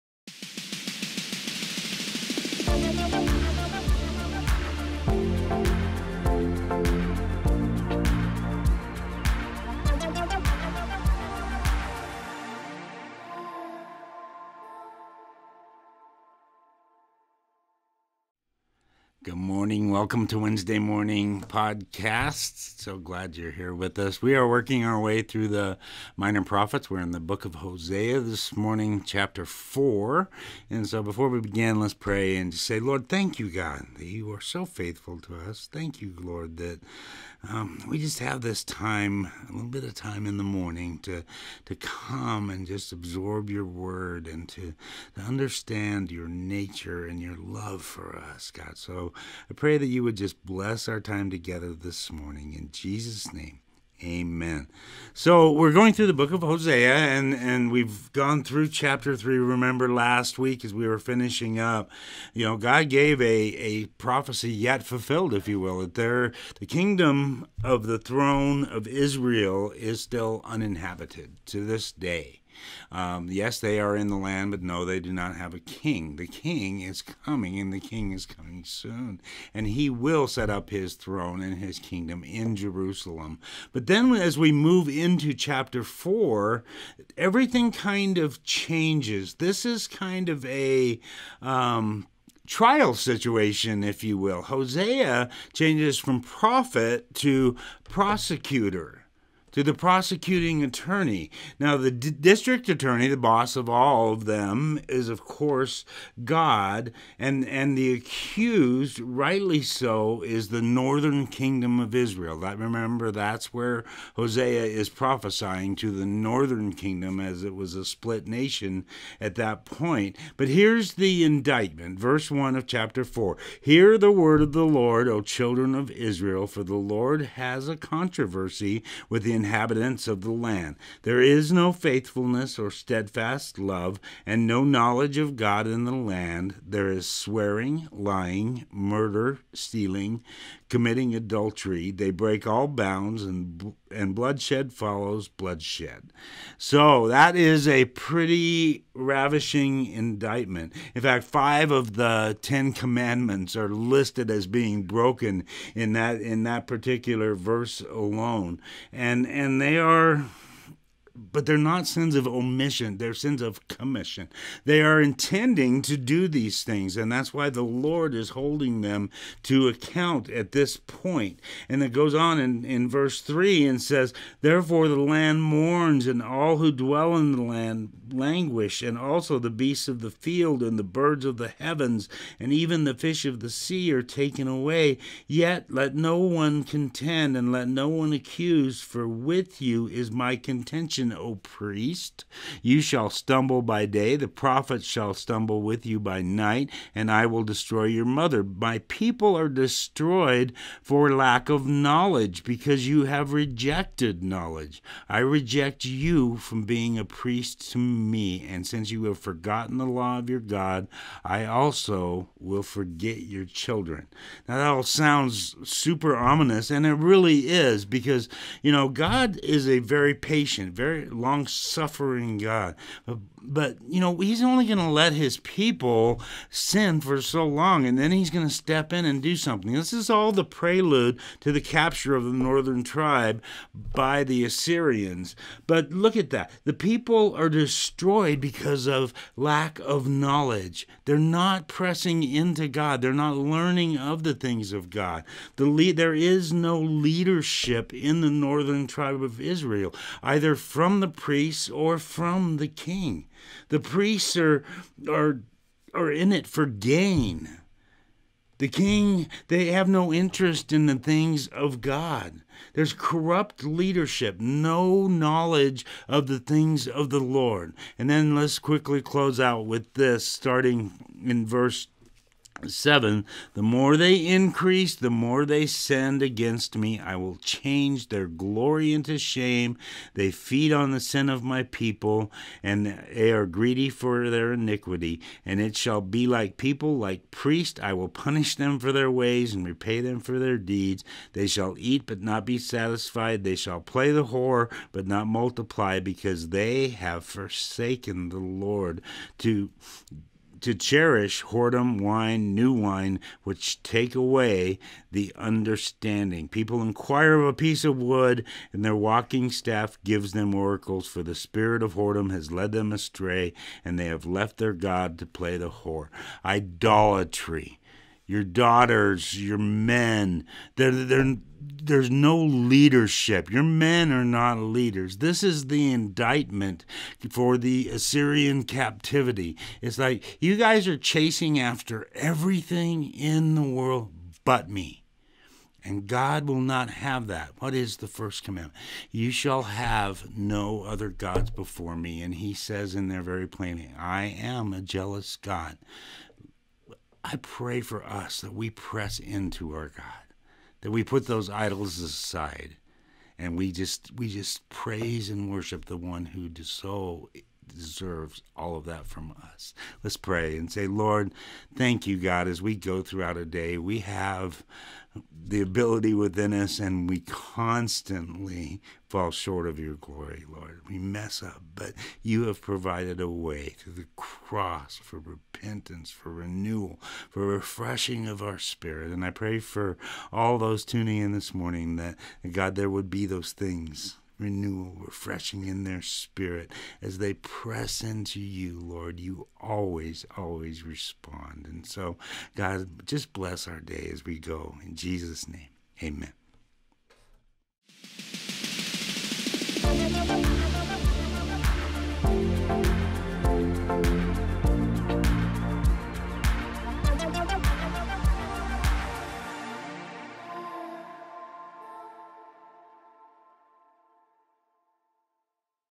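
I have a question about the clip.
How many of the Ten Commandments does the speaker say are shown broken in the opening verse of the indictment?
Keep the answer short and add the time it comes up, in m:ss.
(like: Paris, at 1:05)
5, at 2:31.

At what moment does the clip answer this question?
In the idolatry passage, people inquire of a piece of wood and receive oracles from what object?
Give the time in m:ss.
5:08.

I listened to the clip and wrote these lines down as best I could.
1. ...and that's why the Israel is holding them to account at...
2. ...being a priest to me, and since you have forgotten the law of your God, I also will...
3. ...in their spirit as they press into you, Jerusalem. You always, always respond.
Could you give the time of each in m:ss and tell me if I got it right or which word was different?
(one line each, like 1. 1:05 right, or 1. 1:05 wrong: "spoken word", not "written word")
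1. 2:46 wrong: "Lord", not "Israel"
2. 3:26 right
3. 6:25 wrong: "Lord", not "Jerusalem".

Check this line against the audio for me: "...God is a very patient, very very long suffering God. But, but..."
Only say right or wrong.
right.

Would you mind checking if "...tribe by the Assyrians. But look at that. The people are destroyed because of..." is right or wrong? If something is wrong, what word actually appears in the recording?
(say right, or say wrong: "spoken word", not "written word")
right.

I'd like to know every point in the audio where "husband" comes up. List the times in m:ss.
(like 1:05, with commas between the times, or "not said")
not said.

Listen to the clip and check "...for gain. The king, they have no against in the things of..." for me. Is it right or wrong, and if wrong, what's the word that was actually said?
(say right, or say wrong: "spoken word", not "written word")
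wrong: "interest", not "against".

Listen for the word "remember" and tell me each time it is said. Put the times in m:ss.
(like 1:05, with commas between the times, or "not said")
0:59, 1:52.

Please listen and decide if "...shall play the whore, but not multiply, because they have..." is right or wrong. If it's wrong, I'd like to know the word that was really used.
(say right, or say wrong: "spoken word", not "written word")
right.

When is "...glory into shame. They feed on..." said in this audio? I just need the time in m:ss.
4:38.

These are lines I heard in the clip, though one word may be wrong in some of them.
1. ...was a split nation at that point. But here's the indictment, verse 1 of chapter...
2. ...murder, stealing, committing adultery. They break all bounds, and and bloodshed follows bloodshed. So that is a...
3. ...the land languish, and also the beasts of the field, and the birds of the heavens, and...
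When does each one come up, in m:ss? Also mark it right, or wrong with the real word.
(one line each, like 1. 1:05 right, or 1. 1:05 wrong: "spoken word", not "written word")
1. 1:57 right
2. 2:18 right
3. 2:57 right.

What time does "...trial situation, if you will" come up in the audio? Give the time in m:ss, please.
1:32.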